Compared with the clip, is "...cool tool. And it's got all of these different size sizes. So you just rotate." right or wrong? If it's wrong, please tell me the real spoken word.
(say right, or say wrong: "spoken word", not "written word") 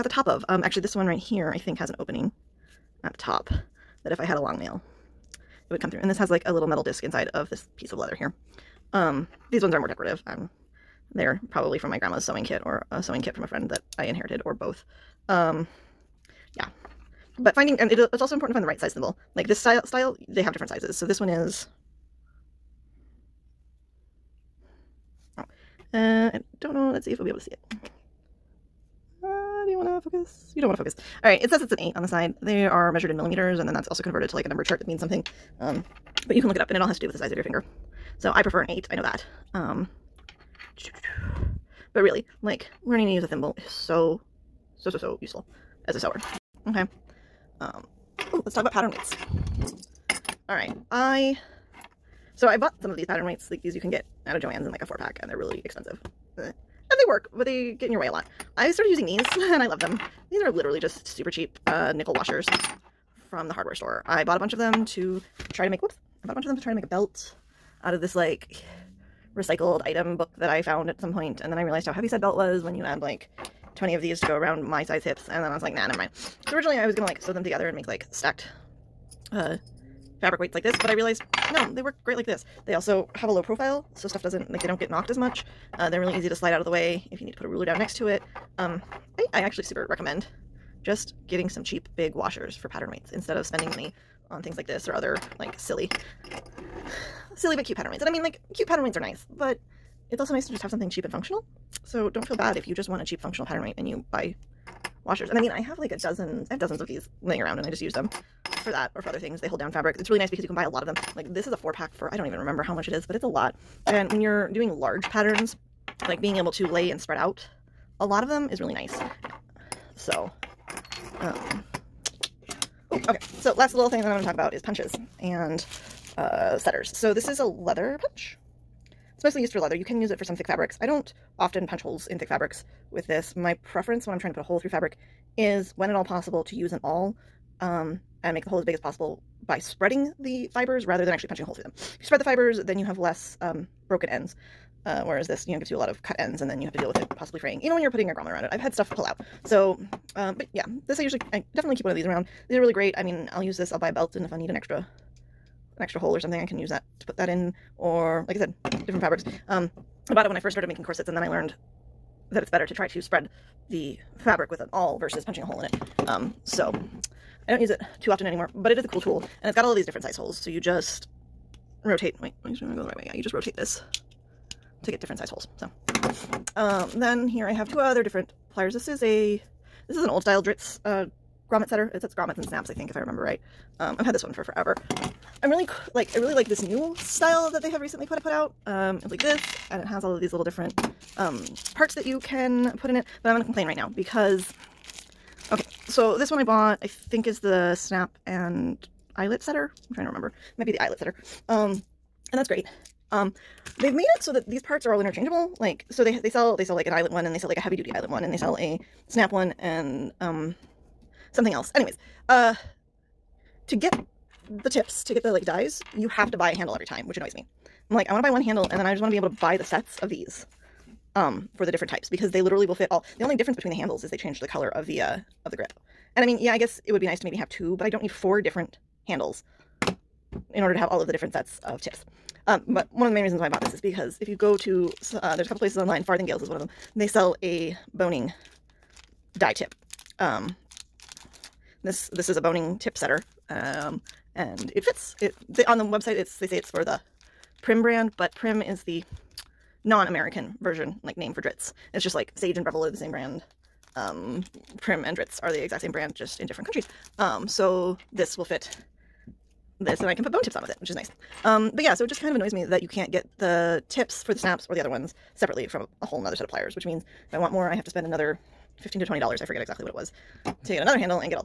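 wrong: "holes", not "sizes".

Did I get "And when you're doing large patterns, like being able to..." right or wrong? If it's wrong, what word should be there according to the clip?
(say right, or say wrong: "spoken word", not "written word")
right.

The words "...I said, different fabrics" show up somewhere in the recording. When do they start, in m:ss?
2:38.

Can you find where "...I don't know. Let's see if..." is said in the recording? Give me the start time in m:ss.
0:26.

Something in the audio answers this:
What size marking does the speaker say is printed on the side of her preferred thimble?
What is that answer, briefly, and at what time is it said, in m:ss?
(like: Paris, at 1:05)
8, at 0:31.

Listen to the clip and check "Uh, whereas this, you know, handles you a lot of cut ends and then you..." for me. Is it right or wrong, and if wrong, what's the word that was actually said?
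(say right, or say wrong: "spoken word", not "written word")
wrong: "gives", not "handles".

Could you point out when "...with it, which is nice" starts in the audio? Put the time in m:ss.
4:20.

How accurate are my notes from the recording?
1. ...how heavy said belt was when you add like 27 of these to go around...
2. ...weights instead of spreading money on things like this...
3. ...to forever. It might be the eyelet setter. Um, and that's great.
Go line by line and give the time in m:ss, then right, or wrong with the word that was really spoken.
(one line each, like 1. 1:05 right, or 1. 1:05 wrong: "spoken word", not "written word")
1. 1:11 wrong: "20", not "27"
2. 1:32 wrong: "spending", not "spreading"
3. 3:20 wrong: "remember", not "forever".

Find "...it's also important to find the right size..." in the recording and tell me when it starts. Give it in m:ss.
0:18.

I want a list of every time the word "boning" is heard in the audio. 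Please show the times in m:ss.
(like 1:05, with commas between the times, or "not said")
3:57, 4:02.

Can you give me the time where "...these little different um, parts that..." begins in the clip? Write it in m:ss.
3:10.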